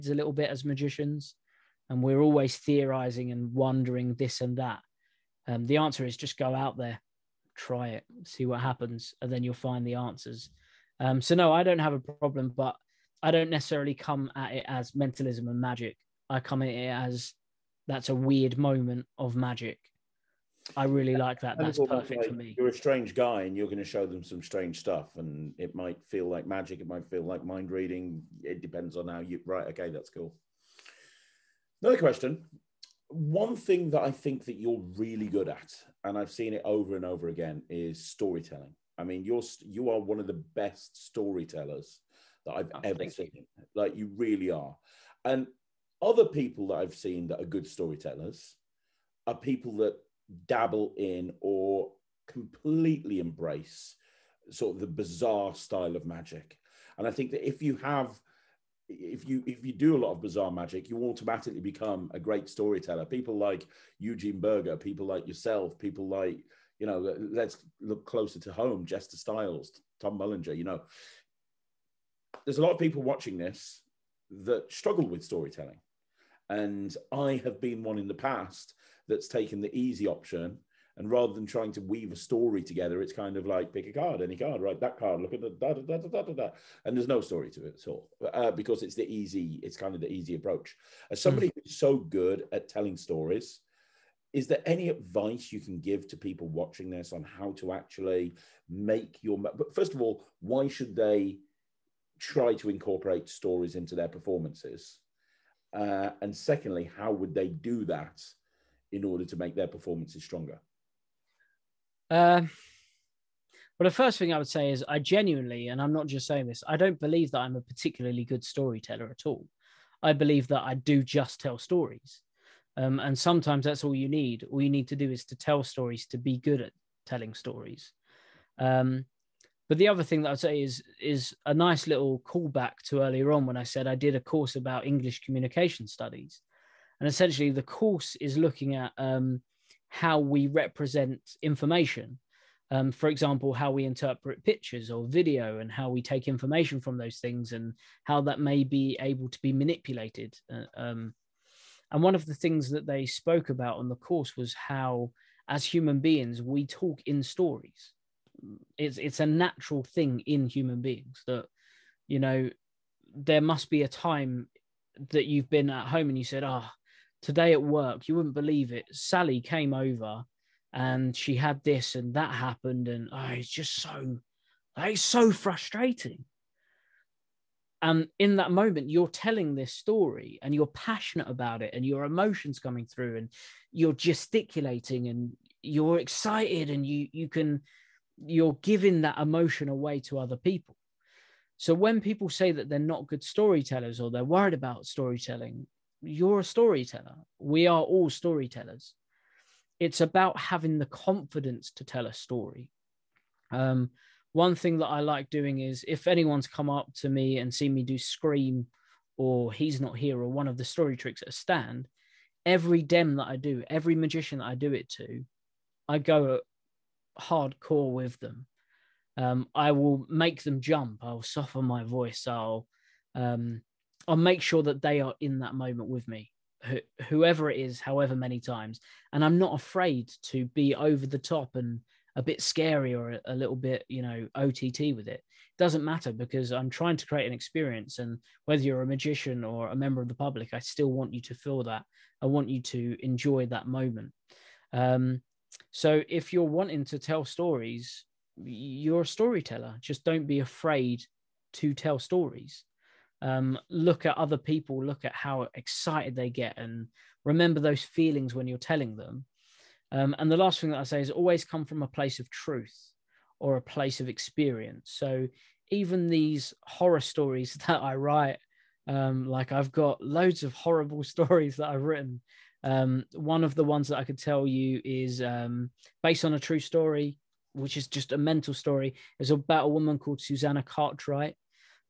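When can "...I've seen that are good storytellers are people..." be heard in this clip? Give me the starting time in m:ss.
0:46.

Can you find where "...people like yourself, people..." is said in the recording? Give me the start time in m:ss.
1:04.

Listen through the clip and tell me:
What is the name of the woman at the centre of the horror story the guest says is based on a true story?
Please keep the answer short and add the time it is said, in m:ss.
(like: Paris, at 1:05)
Susanna Cartwright, at 4:40.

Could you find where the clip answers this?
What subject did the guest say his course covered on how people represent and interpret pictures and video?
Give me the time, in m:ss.
2:14.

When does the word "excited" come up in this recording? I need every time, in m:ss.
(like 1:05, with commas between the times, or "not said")
3:05, 4:15.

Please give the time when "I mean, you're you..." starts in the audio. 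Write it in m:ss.
0:38.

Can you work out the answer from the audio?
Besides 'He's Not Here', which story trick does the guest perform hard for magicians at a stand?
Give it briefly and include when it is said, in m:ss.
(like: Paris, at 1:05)
Scream, at 3:27.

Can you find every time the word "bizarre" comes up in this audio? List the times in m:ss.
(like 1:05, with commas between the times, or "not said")
0:54, 1:00.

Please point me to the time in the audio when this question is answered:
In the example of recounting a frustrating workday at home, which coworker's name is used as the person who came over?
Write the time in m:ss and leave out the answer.
2:48.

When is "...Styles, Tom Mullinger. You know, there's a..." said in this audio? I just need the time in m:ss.
1:09.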